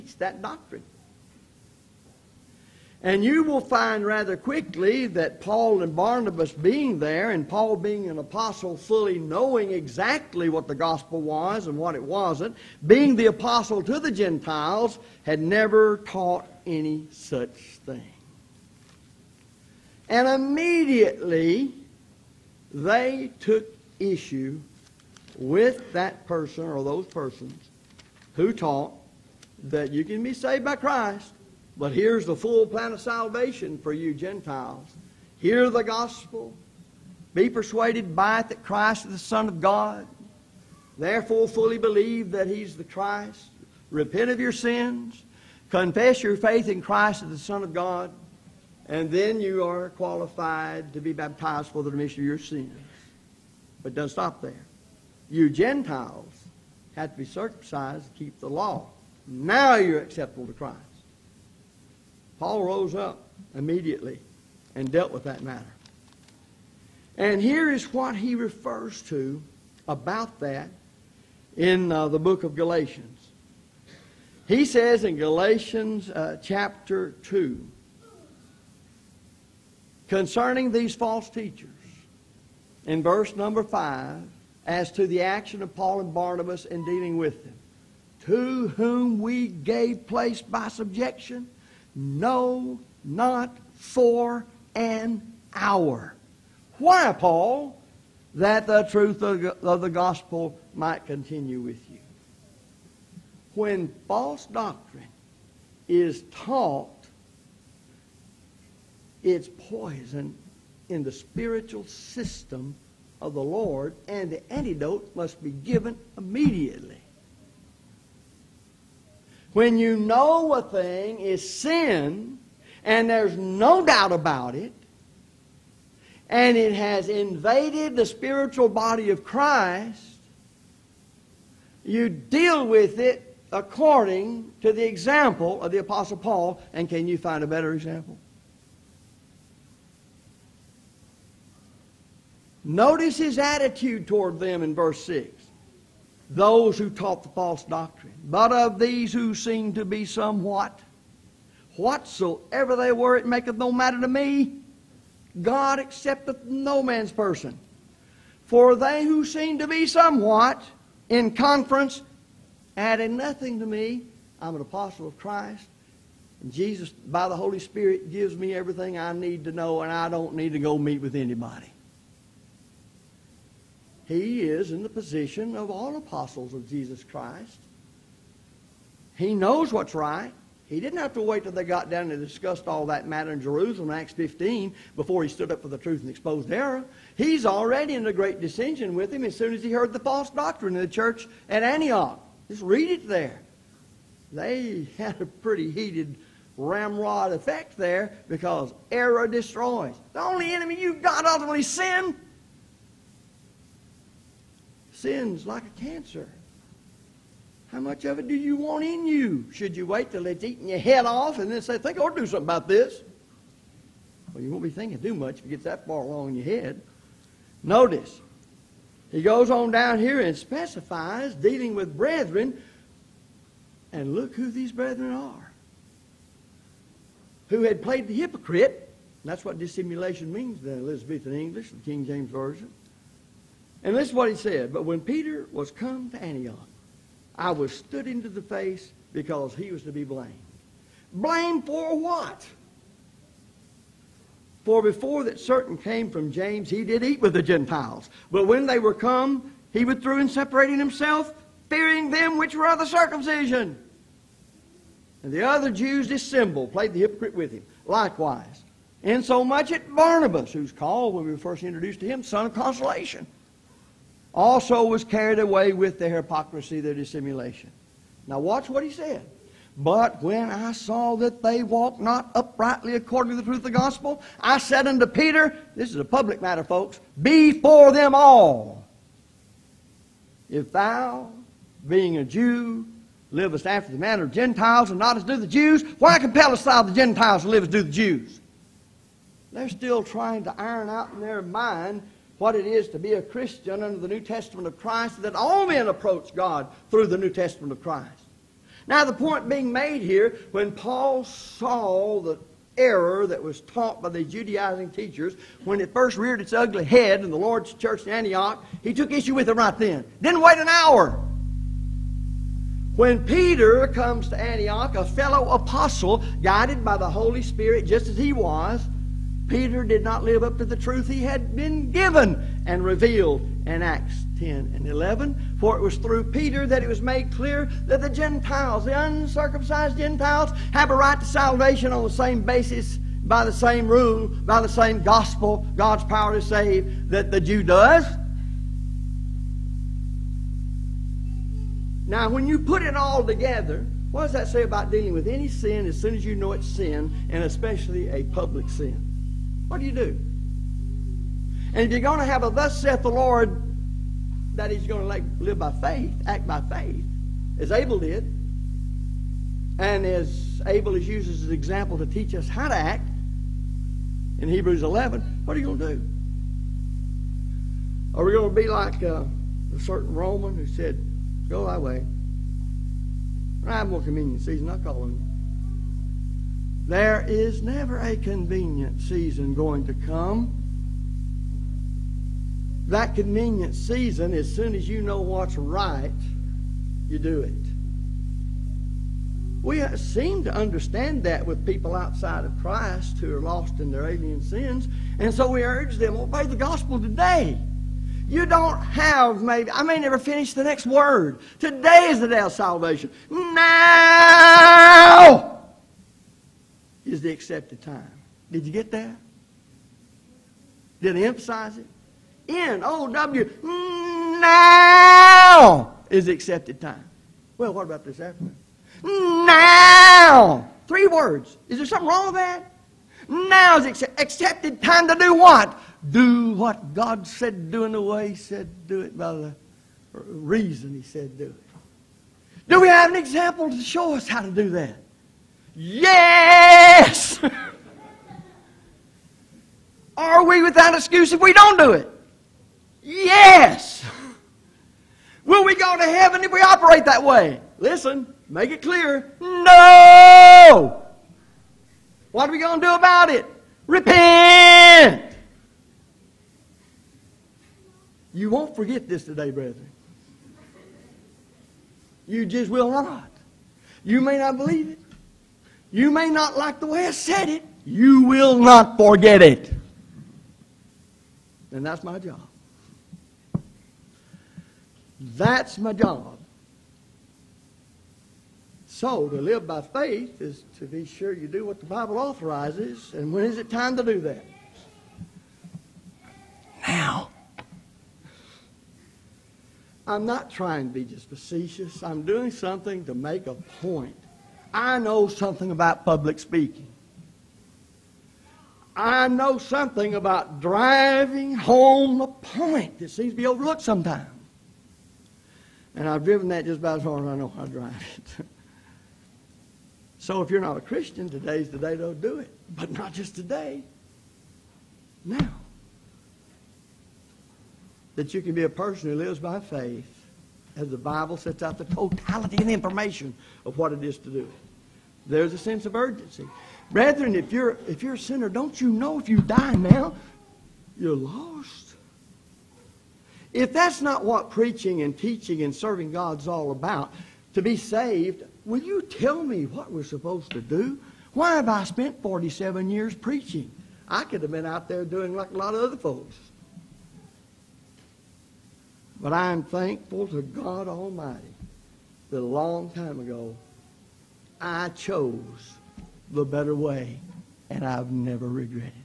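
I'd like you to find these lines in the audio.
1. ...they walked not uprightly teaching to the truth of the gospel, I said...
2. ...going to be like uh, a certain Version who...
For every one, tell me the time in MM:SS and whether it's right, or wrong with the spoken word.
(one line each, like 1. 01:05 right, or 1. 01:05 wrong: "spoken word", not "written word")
1. 04:31 wrong: "according", not "teaching"
2. 06:08 wrong: "Roman", not "Version".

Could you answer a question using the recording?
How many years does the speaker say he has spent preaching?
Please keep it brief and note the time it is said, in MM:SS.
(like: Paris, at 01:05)
47, at 09:02.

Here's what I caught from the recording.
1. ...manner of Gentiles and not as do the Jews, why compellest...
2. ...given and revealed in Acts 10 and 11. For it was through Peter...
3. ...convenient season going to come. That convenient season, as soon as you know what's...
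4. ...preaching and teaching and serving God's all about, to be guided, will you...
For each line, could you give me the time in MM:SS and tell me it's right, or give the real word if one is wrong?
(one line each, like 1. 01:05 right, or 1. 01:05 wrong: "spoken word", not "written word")
1. 04:43 right
2. 05:21 right
3. 06:18 right
4. 08:54 wrong: "saved", not "guided".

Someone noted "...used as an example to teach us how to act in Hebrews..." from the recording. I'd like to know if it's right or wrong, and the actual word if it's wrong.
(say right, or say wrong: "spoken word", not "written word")
right.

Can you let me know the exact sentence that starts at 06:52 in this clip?
N O W now is the accepted time.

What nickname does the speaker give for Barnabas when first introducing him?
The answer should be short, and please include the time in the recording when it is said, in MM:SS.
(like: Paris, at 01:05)
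son of consolation, at 04:22.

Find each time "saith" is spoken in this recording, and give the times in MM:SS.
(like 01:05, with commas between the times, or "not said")
05:52.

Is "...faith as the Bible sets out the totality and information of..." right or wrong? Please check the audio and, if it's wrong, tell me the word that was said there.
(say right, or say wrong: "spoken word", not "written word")
right.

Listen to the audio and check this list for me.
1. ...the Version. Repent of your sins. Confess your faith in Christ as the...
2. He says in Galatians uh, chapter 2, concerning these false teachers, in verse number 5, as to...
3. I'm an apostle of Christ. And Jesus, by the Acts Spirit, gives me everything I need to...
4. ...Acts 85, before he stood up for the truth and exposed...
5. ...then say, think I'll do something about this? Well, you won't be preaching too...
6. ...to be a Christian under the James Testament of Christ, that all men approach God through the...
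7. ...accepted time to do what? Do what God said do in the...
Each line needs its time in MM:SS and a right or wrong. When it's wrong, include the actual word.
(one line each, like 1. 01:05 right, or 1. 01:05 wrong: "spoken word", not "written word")
1. 00:42 wrong: "Christ", not "Version"
2. 01:14 right
3. 02:44 wrong: "Holy", not "Acts"
4. 03:03 wrong: "15", not "85"
5. 03:31 wrong: "thinking", not "preaching"
6. 04:52 wrong: "New", not "James"
7. 07:04 right.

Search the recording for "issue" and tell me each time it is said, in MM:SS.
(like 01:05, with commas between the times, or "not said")
00:23, 05:09.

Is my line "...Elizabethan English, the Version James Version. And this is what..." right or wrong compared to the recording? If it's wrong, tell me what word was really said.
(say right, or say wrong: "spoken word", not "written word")
wrong: "King", not "Version".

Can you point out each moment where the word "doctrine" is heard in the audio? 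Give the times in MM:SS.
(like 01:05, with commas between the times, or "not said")
00:00, 01:44, 02:27, 03:10.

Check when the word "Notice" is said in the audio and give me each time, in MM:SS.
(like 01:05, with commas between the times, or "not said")
02:22, 03:37.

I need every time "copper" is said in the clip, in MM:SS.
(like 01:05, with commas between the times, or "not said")
not said.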